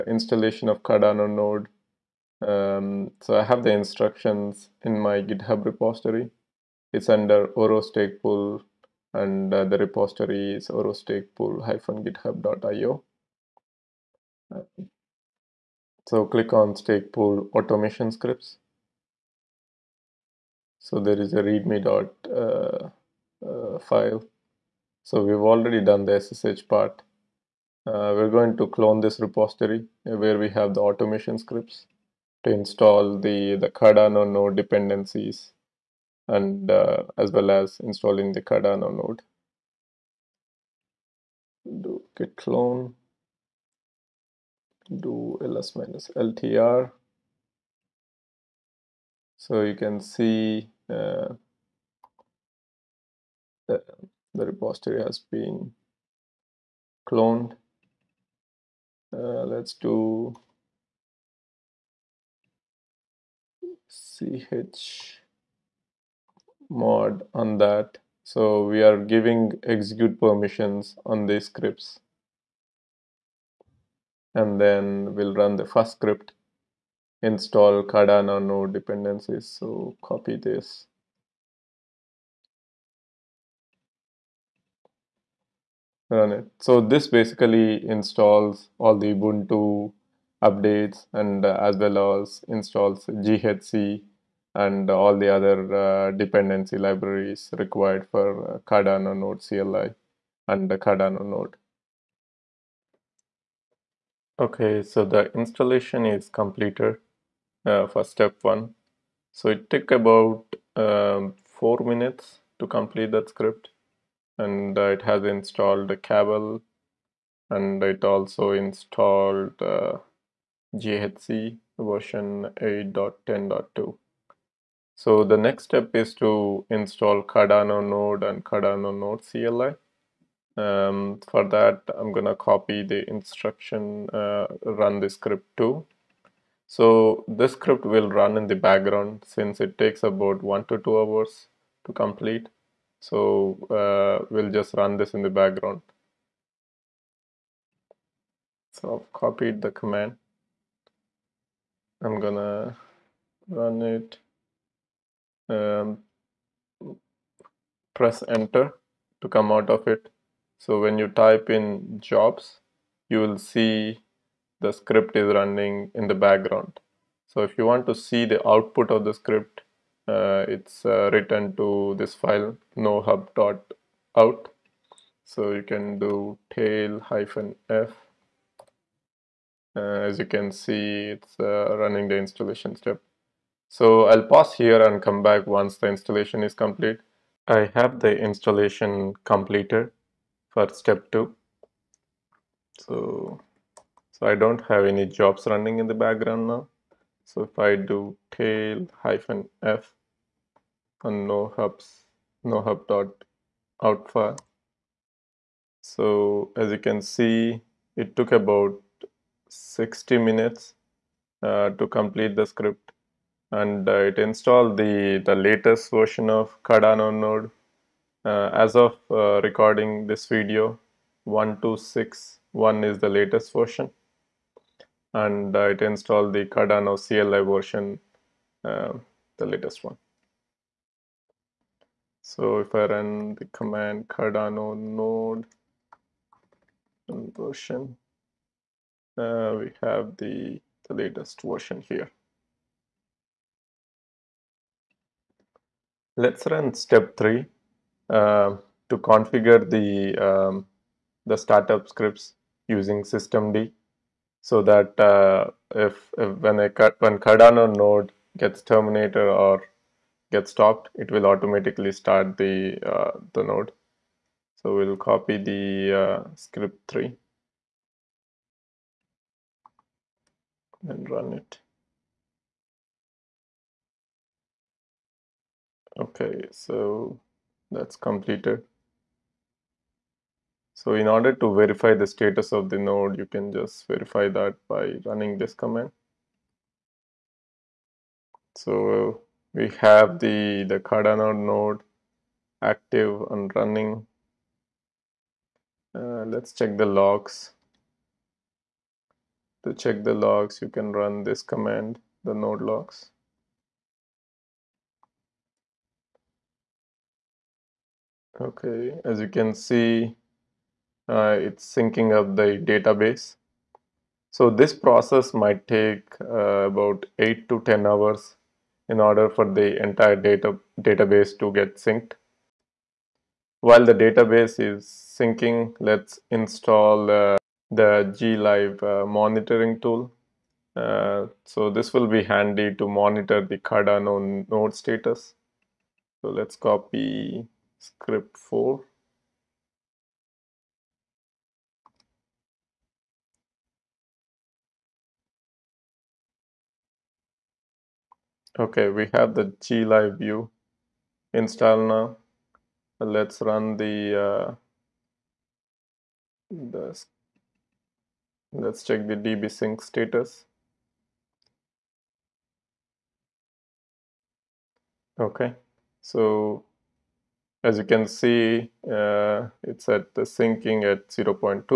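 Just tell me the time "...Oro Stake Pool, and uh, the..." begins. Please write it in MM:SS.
00:07.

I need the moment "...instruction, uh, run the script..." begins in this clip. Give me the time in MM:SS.
02:13.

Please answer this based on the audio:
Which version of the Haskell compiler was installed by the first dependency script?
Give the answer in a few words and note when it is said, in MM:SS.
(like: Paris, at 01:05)
8.10.2, at 02:02.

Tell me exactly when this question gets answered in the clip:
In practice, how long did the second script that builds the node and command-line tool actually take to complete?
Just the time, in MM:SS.
03:29.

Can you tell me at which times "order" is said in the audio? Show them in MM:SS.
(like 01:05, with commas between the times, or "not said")
04:41, 05:18.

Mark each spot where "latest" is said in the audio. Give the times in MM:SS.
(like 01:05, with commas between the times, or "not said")
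03:35, 03:43, 03:49, 04:00.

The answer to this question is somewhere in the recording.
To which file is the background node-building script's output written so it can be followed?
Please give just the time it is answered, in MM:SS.
02:52.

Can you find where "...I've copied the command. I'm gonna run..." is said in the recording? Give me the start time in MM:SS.
02:28.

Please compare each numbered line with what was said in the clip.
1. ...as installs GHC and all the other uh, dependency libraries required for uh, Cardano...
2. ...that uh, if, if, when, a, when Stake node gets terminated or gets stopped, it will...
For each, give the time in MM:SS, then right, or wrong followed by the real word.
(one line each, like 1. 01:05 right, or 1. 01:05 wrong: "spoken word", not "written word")
1. 01:32 right
2. 04:14 wrong: "Cardano", not "Stake".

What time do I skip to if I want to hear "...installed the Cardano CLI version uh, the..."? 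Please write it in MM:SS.
03:45.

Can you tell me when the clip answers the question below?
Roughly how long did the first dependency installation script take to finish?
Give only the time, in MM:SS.
01:51.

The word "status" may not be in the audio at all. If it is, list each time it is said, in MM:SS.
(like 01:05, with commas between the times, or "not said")
04:42, 05:34, 05:59.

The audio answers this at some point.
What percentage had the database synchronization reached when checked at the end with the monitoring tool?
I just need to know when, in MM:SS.
06:11.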